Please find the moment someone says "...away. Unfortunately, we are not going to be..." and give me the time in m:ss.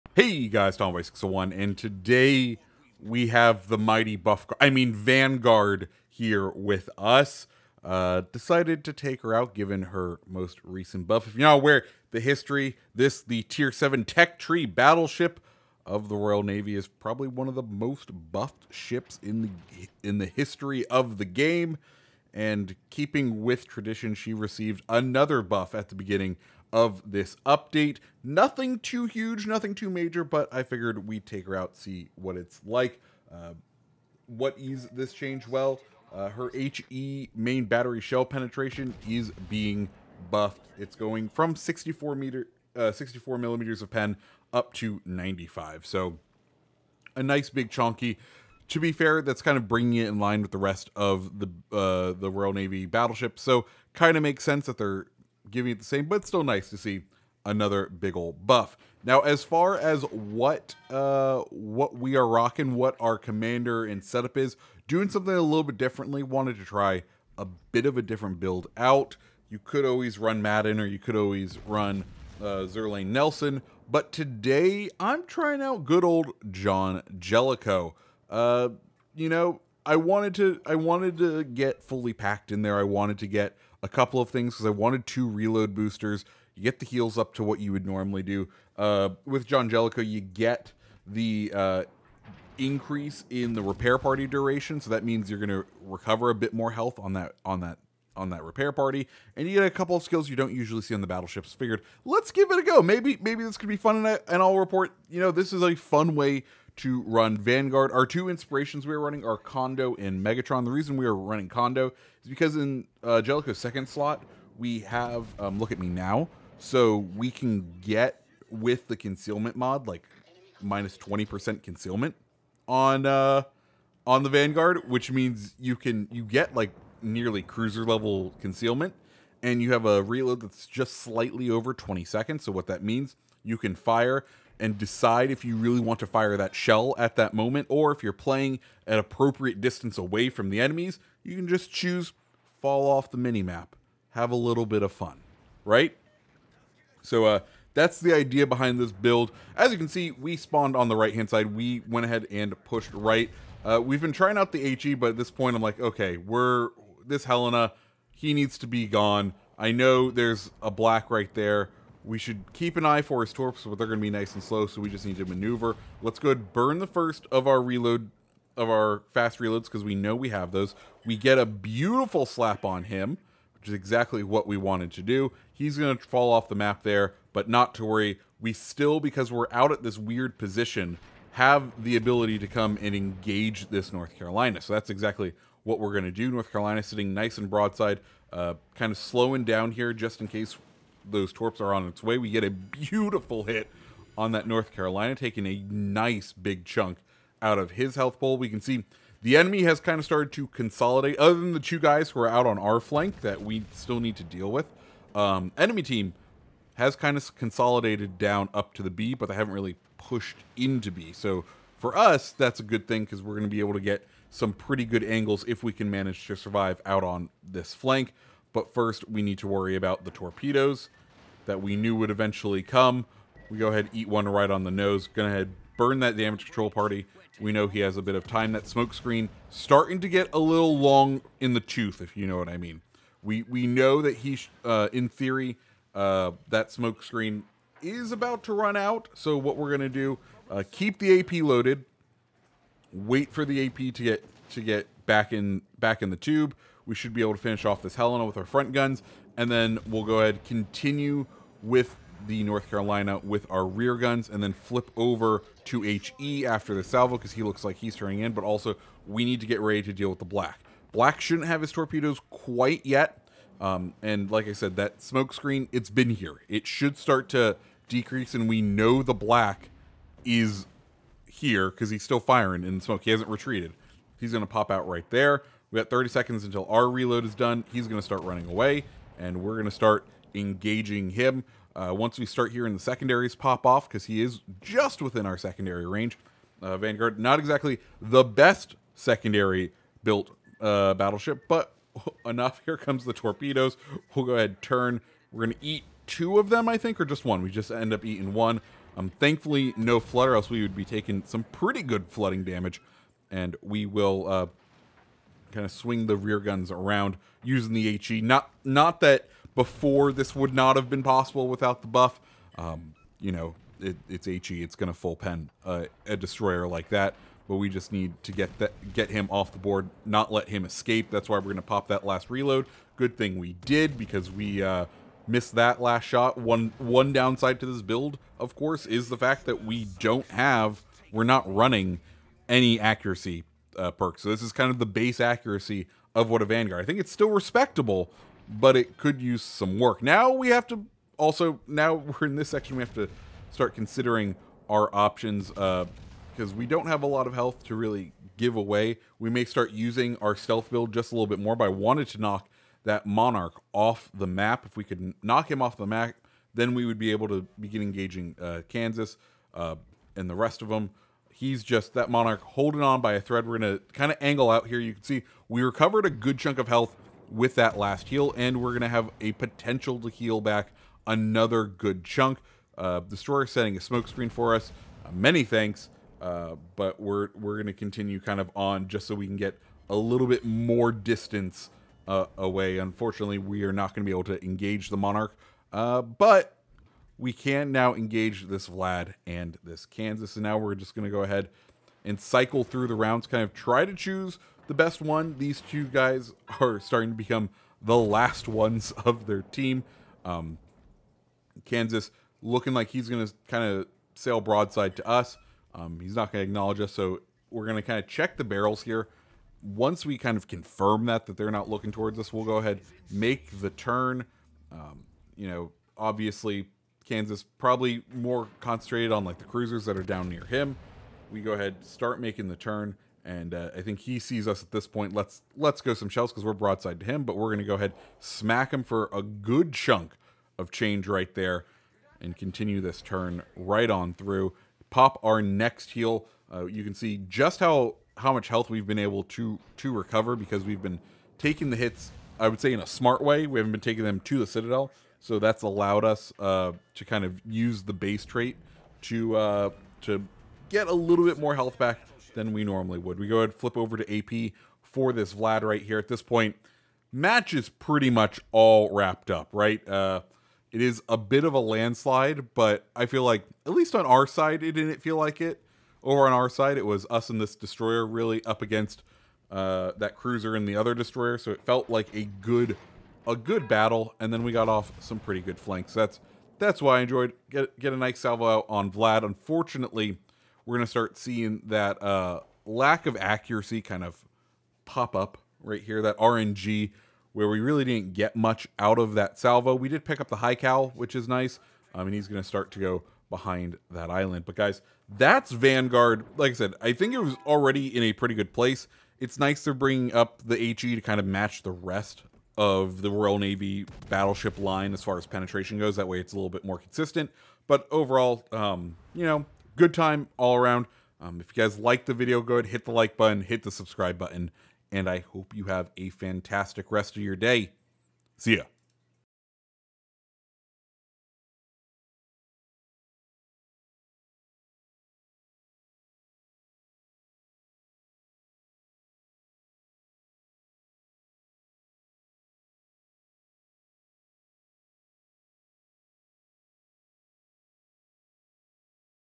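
6:22.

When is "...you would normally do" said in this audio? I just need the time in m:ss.
1:27.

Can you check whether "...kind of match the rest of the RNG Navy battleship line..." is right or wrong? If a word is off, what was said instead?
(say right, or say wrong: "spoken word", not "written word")
wrong: "Royal", not "RNG".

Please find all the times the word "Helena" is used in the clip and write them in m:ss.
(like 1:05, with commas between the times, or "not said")
2:37, 4:07.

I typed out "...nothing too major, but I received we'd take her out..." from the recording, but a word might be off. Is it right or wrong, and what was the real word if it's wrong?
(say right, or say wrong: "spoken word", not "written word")
wrong: "figured", not "received".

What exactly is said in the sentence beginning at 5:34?
So this is kind of the base accuracy of what a Vanguard.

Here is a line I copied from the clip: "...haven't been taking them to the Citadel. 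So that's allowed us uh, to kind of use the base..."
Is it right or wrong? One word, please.
right.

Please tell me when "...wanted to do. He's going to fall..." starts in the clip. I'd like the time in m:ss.
2:54.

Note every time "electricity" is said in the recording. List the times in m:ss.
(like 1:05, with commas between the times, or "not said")
not said.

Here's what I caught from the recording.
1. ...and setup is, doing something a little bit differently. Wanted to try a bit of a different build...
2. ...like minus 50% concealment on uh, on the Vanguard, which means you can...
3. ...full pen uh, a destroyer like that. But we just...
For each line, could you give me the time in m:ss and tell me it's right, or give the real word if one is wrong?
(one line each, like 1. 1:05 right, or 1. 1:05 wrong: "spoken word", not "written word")
1. 1:03 right
2. 1:59 wrong: "20", not "50"
3. 5:14 right.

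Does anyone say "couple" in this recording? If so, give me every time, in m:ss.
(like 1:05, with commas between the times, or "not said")
1:23, 1:39.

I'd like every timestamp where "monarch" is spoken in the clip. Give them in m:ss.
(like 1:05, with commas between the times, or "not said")
5:53, 6:02, 6:24.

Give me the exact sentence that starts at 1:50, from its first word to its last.
The reason we are running Kondo is because in uh, Jellicoe's second slot, we have um, Look at Me Now.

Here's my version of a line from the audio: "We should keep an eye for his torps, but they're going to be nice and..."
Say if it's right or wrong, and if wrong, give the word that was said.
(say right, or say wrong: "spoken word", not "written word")
right.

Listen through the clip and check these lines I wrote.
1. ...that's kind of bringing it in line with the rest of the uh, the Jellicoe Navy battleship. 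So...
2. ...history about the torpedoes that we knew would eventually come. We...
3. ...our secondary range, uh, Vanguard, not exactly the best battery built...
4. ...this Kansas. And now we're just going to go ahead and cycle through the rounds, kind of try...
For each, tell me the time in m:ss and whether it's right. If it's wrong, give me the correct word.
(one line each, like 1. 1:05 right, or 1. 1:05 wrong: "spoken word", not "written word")
1. 0:49 wrong: "Royal", not "Jellicoe"
2. 3:39 wrong: "worry", not "history"
3. 4:45 wrong: "secondary", not "battery"
4. 6:29 right.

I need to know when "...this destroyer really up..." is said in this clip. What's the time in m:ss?
7:47.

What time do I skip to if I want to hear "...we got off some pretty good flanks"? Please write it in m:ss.
7:54.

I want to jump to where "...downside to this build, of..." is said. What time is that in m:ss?
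5:27.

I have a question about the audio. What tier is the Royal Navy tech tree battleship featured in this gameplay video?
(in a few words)
7.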